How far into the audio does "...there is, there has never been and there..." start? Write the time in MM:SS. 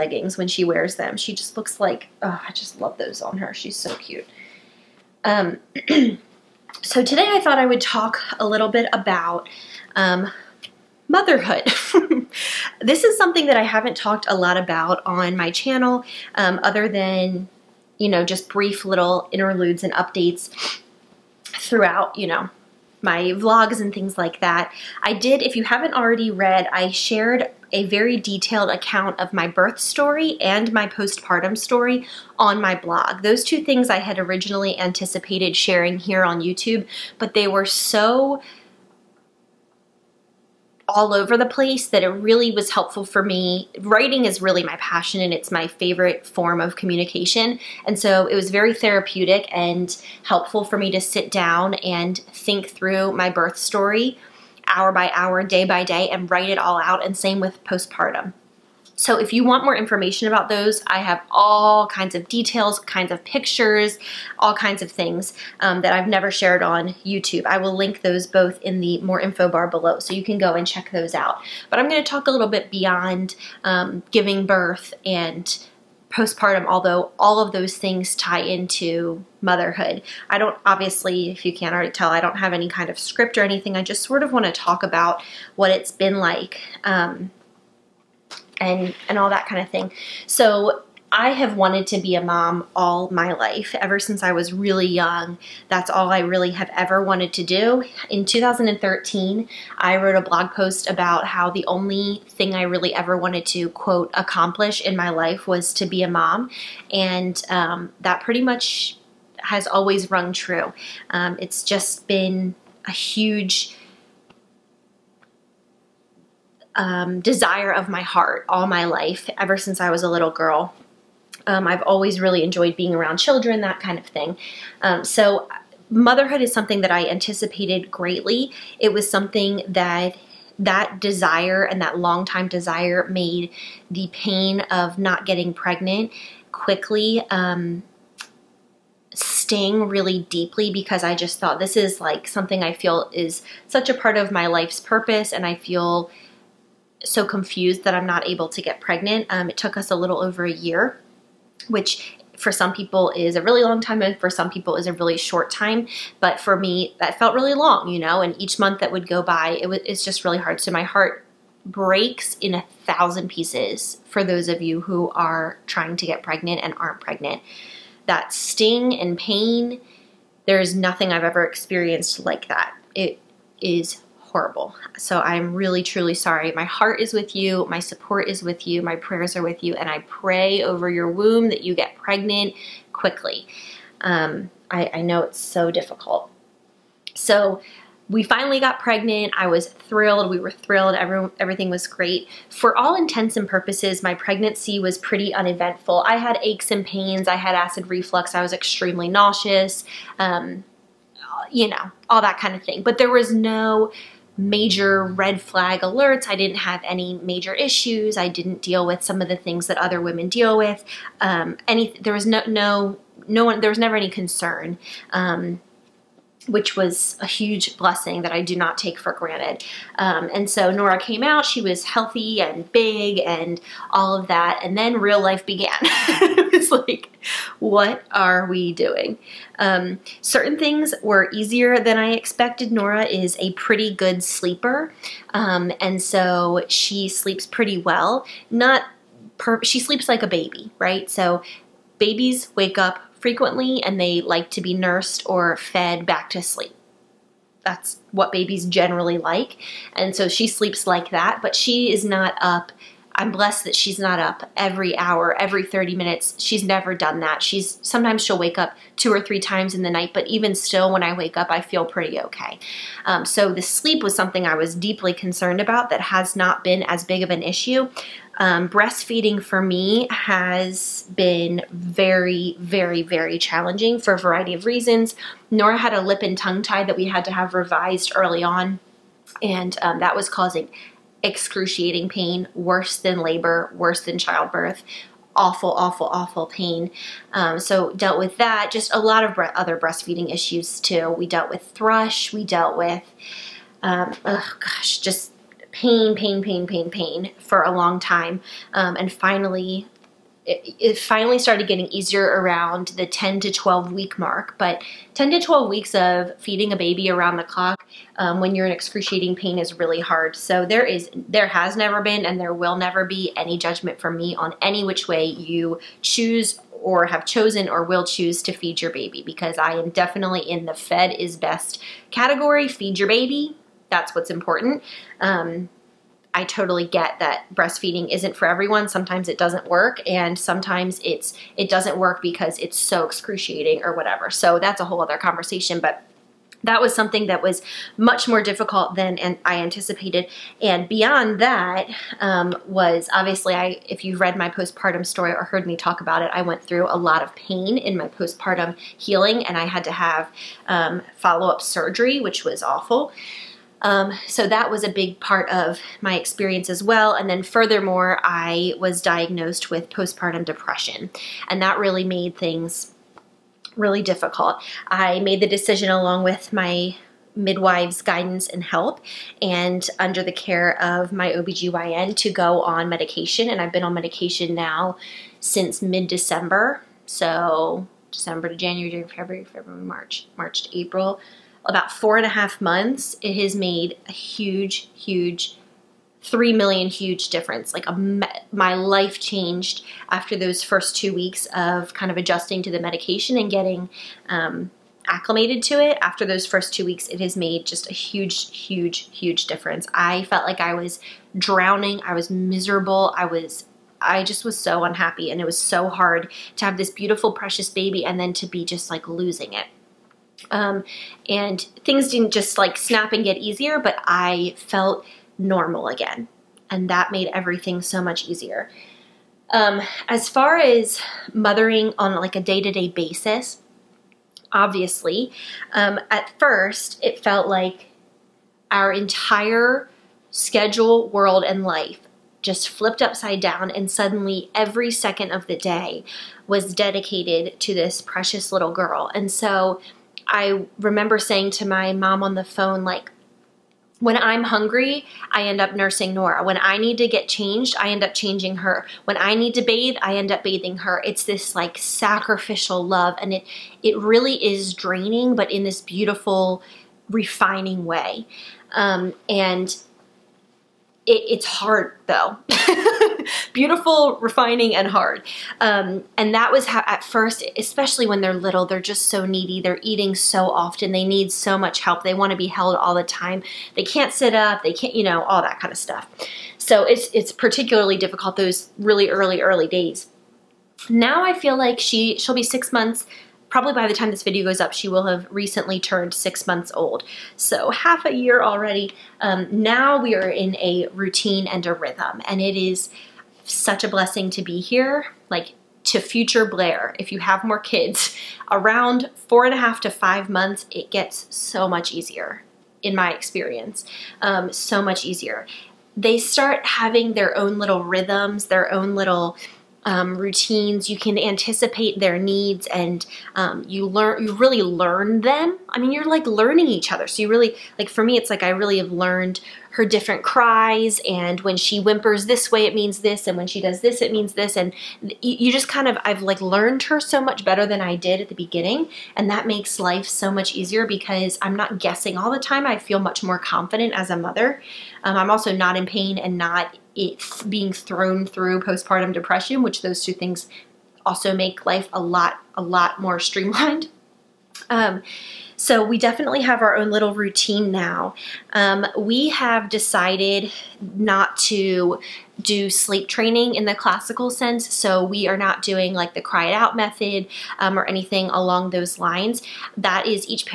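05:10.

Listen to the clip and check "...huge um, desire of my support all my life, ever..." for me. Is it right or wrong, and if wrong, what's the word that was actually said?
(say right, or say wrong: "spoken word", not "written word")
wrong: "heart", not "support".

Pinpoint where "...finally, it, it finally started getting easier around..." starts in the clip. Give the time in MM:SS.
04:59.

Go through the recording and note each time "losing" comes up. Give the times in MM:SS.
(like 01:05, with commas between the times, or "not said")
06:49.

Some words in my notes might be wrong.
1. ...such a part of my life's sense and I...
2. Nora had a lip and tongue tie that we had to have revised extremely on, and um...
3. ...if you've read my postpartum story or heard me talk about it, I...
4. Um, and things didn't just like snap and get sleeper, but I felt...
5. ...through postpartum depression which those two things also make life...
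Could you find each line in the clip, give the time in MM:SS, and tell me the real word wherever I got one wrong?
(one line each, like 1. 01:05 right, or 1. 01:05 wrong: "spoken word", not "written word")
1. 02:23 wrong: "purpose", not "sense"
2. 04:35 wrong: "early", not "extremely"
3. 05:43 right
4. 06:50 wrong: "easier", not "sleeper"
5. 08:58 right.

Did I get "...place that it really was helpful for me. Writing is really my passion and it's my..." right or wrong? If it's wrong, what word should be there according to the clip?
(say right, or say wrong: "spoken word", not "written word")
right.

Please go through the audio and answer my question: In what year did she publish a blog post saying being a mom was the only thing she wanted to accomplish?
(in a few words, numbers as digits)
2013.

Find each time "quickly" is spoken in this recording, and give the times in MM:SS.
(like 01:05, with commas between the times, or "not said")
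02:16, 03:02.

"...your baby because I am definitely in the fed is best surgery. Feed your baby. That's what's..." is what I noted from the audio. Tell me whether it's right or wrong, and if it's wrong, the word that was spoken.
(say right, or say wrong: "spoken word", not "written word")
wrong: "category", not "surgery".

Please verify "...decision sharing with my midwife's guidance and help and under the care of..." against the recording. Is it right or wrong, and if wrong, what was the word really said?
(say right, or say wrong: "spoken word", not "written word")
wrong: "along", not "sharing".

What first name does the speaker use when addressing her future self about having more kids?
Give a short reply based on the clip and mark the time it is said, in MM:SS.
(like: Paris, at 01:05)
Blair, at 08:16.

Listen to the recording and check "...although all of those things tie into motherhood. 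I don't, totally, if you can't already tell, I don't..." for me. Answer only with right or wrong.
wrong.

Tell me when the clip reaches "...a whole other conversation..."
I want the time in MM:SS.
05:34.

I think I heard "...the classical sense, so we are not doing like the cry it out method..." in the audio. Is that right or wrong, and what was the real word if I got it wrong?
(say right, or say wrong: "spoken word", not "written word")
right.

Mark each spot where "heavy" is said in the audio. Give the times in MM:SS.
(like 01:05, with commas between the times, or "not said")
not said.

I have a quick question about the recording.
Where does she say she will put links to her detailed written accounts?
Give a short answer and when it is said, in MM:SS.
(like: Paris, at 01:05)
More info bar, at 01:09.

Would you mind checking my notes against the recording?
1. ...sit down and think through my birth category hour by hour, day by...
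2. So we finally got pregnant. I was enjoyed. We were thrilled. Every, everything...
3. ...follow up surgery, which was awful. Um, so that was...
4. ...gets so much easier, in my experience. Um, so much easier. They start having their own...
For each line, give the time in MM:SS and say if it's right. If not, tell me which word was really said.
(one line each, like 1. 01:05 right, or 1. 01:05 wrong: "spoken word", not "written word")
1. 00:51 wrong: "story", not "category"
2. 03:07 wrong: "thrilled", not "enjoyed"
3. 05:51 right
4. 08:20 right.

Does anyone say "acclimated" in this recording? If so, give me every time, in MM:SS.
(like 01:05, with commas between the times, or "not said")
06:35.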